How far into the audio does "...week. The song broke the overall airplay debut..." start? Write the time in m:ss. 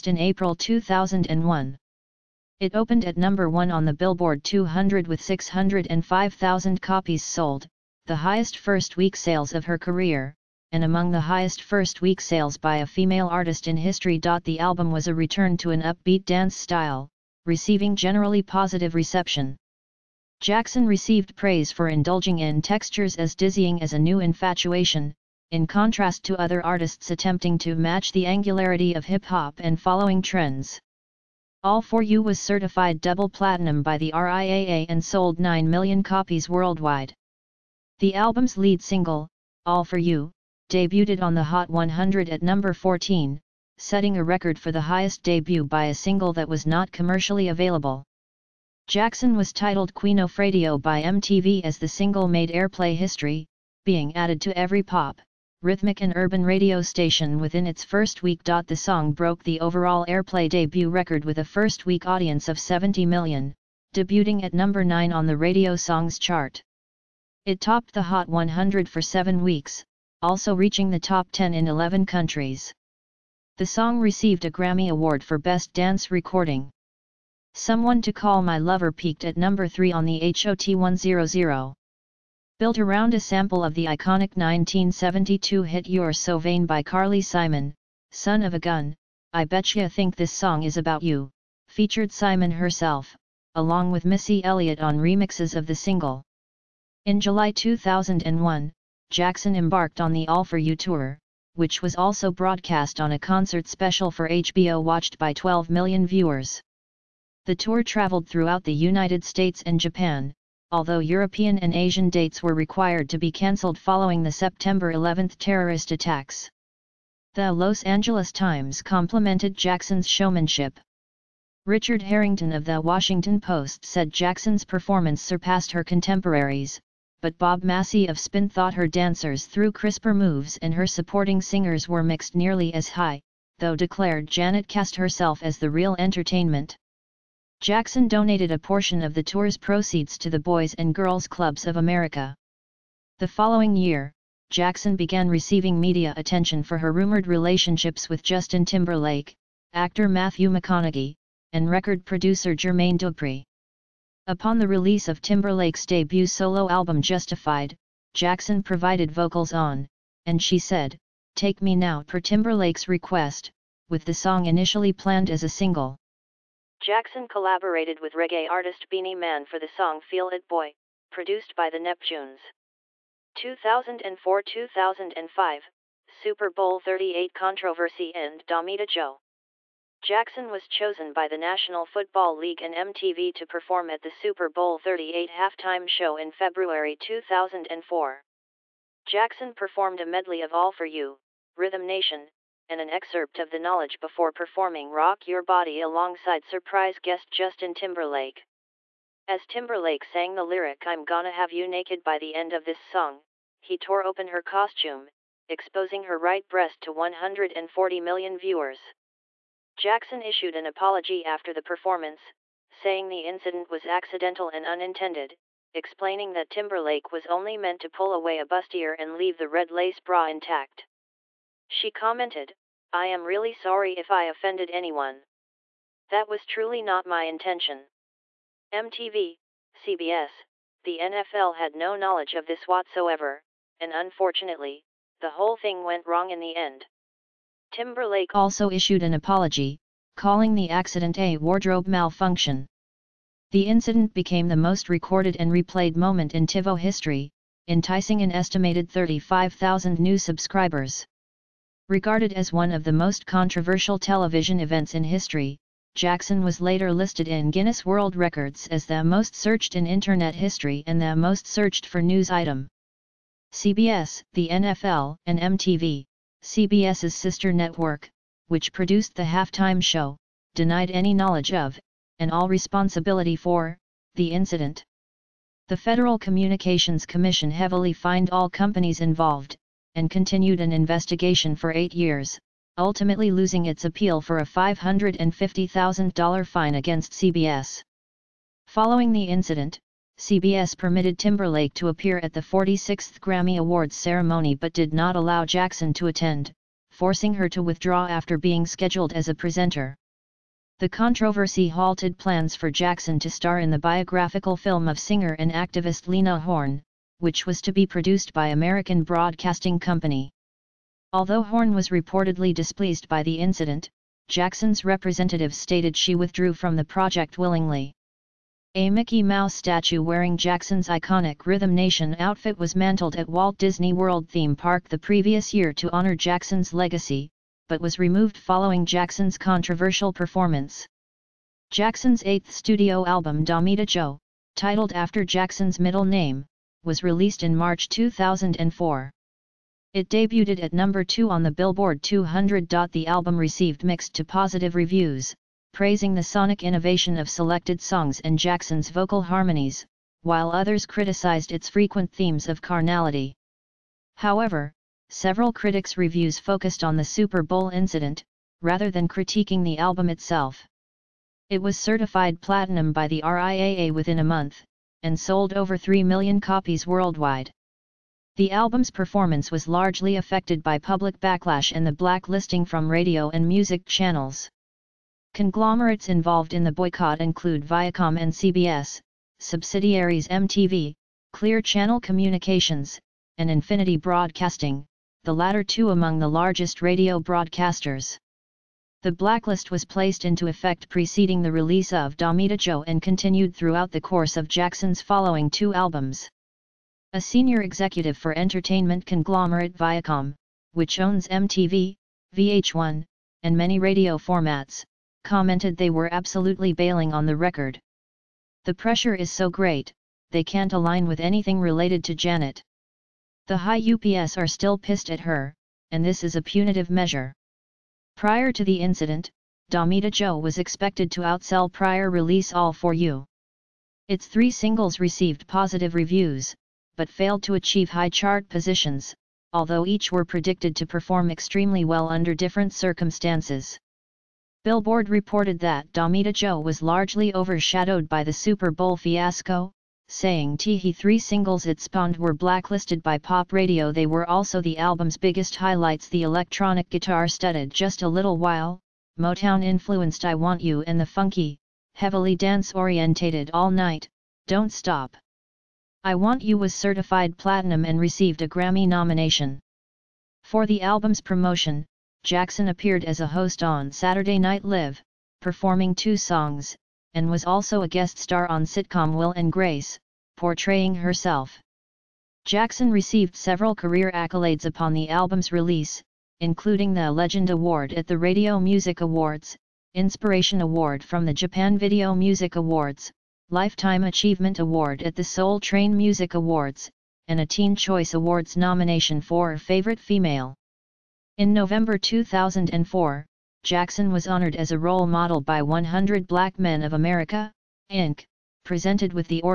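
0:58.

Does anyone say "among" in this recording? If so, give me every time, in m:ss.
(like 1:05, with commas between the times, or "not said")
0:10, 6:25.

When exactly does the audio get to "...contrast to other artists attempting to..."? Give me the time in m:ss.
0:25.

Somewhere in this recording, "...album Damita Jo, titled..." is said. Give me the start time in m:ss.
5:33.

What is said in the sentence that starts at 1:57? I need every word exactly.
The Los Angeles Times complimented Jackson's showmanship.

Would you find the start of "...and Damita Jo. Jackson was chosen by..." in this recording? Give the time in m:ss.
2:58.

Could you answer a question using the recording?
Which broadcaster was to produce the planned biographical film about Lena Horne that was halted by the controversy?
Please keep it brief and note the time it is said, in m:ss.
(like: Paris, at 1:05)
American Broadcasting Company, at 5:08.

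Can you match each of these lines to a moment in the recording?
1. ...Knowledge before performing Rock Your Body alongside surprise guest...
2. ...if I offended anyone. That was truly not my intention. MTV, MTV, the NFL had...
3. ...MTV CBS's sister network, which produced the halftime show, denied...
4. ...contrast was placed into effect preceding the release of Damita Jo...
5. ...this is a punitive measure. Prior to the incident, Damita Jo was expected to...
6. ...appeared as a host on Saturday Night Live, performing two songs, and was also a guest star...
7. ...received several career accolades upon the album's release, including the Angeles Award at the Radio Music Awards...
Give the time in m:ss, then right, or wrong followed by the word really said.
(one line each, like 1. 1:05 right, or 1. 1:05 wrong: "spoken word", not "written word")
1. 3:13 right
2. 3:43 wrong: "CBS", not "MTV"
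3. 4:25 right
4. 6:29 wrong: "blacklist", not "contrast"
5. 6:56 right
6. 7:42 right
7. 7:52 wrong: "Legend", not "Angeles".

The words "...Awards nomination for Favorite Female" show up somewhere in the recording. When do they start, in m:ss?
8:08.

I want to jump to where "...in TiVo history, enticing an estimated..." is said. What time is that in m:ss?
4:06.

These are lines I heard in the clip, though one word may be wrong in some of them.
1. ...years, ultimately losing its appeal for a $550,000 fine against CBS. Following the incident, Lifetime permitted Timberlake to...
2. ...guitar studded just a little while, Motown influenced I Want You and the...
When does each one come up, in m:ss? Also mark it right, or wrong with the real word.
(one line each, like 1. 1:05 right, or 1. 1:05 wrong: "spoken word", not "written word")
1. 4:41 wrong: "CBS", not "Lifetime"
2. 7:26 right.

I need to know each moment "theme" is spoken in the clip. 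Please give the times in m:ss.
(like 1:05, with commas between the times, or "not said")
5:24, 5:52.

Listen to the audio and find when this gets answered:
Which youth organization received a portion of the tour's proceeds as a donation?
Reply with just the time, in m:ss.
2:20.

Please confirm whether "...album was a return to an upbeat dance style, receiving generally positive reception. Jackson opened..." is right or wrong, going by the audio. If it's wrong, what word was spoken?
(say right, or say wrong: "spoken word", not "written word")
wrong: "received", not "opened".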